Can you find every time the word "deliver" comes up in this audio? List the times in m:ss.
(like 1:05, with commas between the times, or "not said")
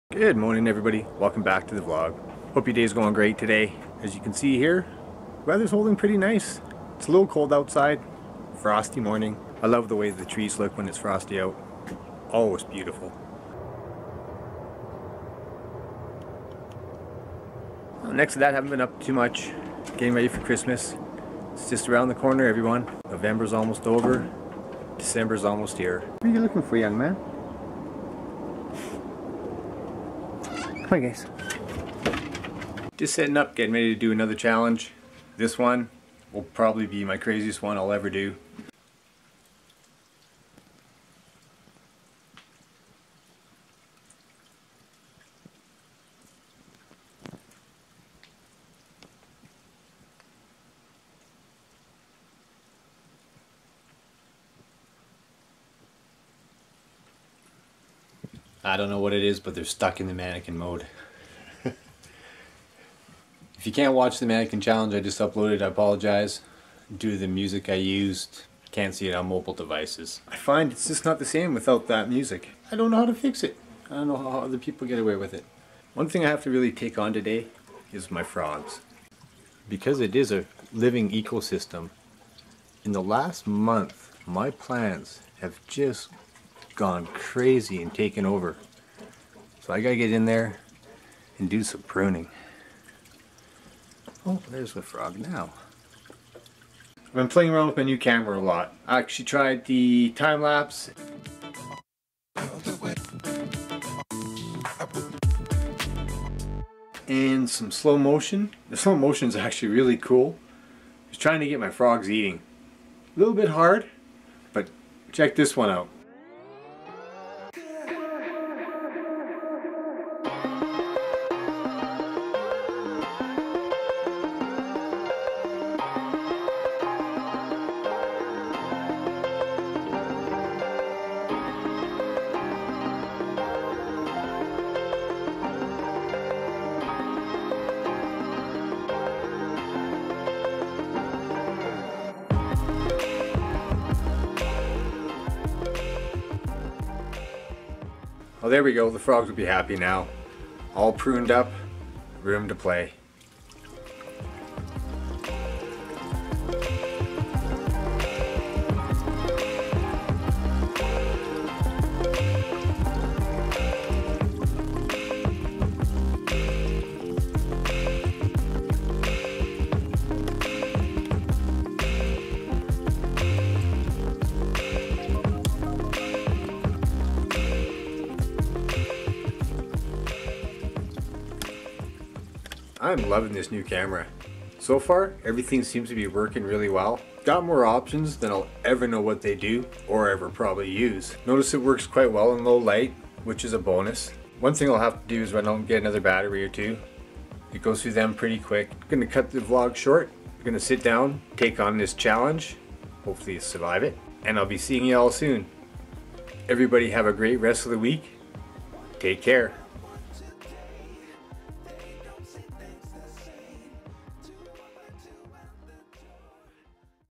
not said.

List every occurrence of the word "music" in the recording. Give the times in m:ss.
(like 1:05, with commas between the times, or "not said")
1:07, 1:12.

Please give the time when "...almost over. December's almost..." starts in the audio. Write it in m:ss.
0:23.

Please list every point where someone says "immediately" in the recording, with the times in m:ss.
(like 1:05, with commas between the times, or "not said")
not said.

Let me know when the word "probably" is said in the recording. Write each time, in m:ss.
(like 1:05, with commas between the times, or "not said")
0:36, 3:10.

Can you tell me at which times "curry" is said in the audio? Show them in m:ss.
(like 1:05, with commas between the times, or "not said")
not said.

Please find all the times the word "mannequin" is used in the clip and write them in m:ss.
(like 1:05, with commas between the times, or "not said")
1:00, 1:04.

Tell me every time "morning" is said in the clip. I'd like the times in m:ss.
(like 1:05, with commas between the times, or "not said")
0:00, 0:08.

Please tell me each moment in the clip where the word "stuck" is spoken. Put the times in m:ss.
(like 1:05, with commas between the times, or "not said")
0:59.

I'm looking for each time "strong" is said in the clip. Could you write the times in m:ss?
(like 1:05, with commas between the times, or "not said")
not said.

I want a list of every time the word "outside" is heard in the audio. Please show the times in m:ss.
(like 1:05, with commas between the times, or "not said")
0:07.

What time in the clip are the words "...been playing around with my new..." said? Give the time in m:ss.
1:37.